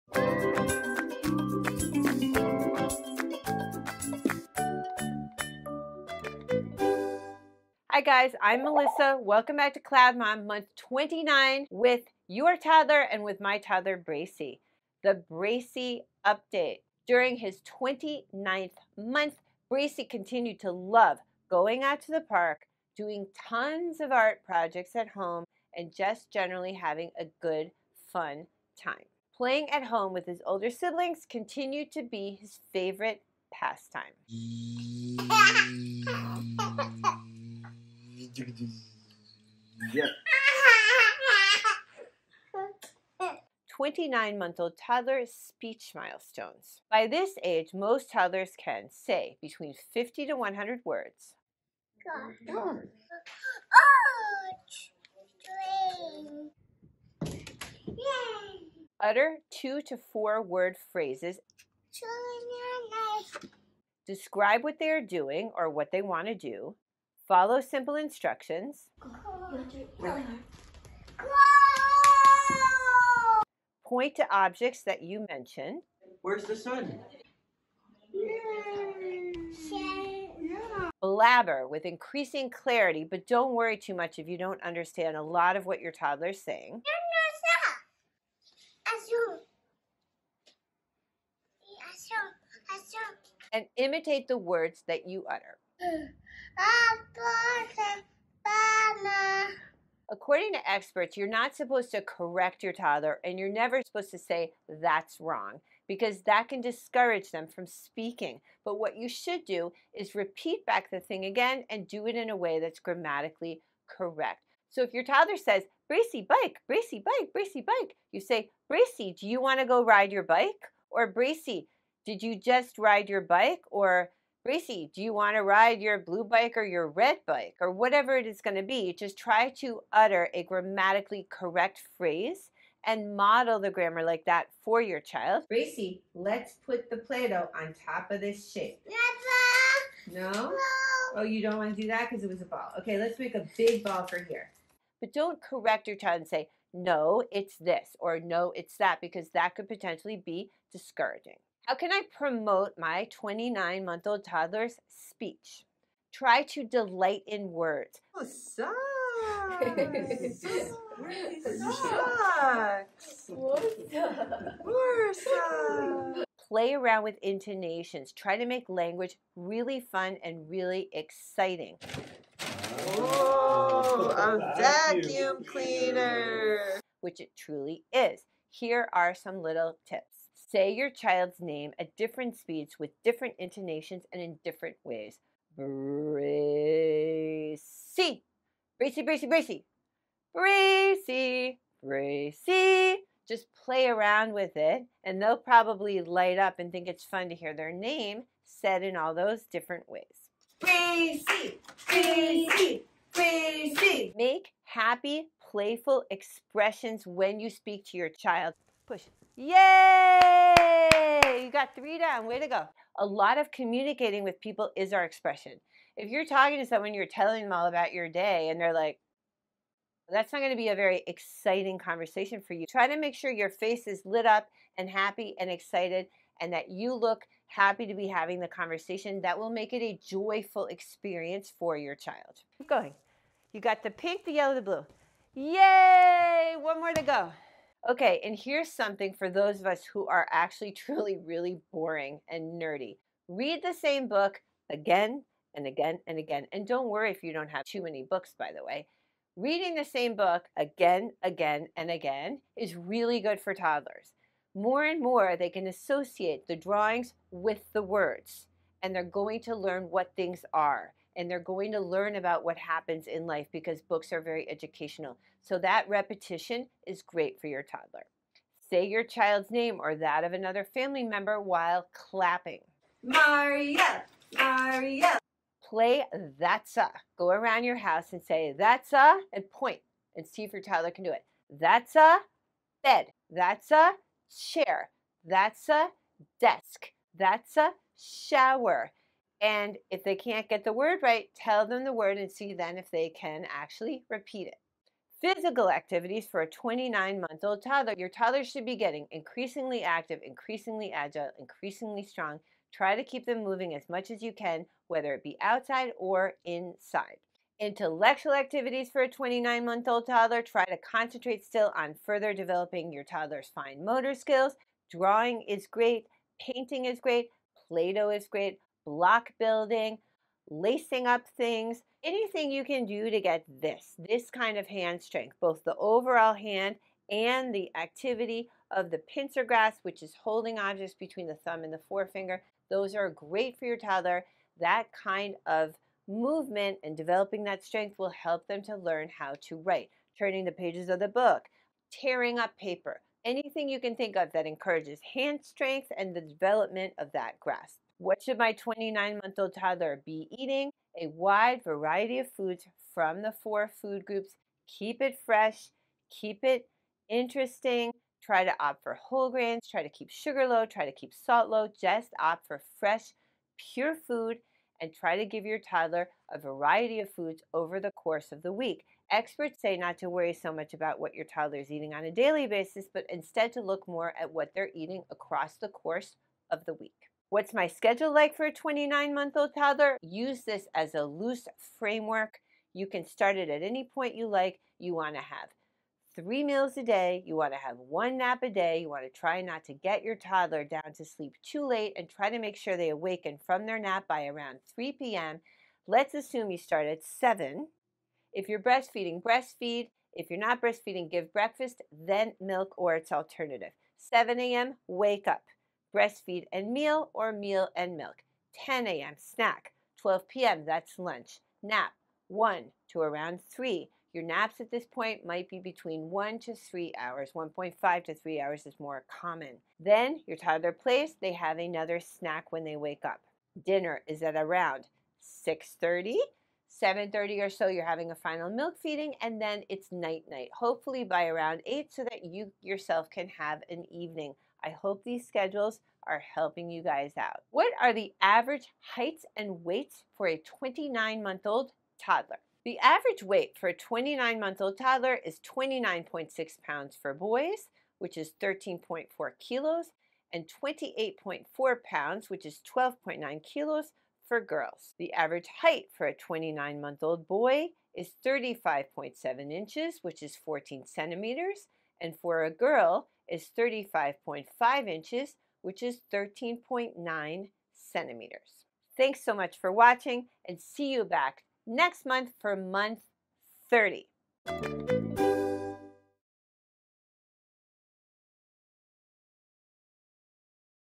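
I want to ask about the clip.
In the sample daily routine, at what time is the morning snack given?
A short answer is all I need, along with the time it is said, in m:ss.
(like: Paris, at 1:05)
10 a.m., at 6:48.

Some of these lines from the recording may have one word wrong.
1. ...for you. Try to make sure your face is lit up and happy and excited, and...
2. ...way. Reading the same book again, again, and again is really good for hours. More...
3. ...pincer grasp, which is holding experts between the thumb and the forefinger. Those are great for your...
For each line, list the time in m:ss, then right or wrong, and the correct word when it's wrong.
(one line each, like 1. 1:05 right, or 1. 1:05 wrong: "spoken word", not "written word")
1. 3:42 right
2. 4:08 wrong: "toddlers", not "hours"
3. 5:28 wrong: "objects", not "experts".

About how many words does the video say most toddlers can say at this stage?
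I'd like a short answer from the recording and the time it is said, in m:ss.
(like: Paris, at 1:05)
50 to 100, at 0:49.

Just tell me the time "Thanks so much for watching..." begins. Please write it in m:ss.
7:48.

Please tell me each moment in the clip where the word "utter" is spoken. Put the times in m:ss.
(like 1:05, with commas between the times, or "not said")
0:59, 1:35, 2:09.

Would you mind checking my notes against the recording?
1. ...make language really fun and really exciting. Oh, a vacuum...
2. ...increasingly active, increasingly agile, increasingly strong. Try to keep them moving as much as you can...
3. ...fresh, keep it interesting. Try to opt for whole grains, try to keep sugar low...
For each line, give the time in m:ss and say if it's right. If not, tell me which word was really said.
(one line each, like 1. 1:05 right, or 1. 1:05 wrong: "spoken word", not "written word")
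1. 2:48 right
2. 4:59 right
3. 5:55 right.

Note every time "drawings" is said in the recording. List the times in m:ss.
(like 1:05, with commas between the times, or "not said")
4:16, 5:14.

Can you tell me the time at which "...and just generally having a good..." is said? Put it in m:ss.
0:25.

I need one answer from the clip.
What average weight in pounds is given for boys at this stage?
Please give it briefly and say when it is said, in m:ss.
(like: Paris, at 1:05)
29.6 pounds, at 7:25.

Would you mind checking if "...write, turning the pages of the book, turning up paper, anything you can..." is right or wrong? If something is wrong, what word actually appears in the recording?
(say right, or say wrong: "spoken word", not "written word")
wrong: "tearing", not "turning".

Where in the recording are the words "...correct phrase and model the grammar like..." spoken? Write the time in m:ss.
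2:11.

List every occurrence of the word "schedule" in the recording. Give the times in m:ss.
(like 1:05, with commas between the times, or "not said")
6:17, 7:15.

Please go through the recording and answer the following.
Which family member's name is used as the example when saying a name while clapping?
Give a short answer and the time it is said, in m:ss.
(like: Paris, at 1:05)
Maria, at 4:33.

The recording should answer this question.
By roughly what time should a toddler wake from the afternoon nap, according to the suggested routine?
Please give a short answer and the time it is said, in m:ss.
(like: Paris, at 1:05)
3 p.m., at 6:34.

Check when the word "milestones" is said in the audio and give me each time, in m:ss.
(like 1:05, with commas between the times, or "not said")
0:45.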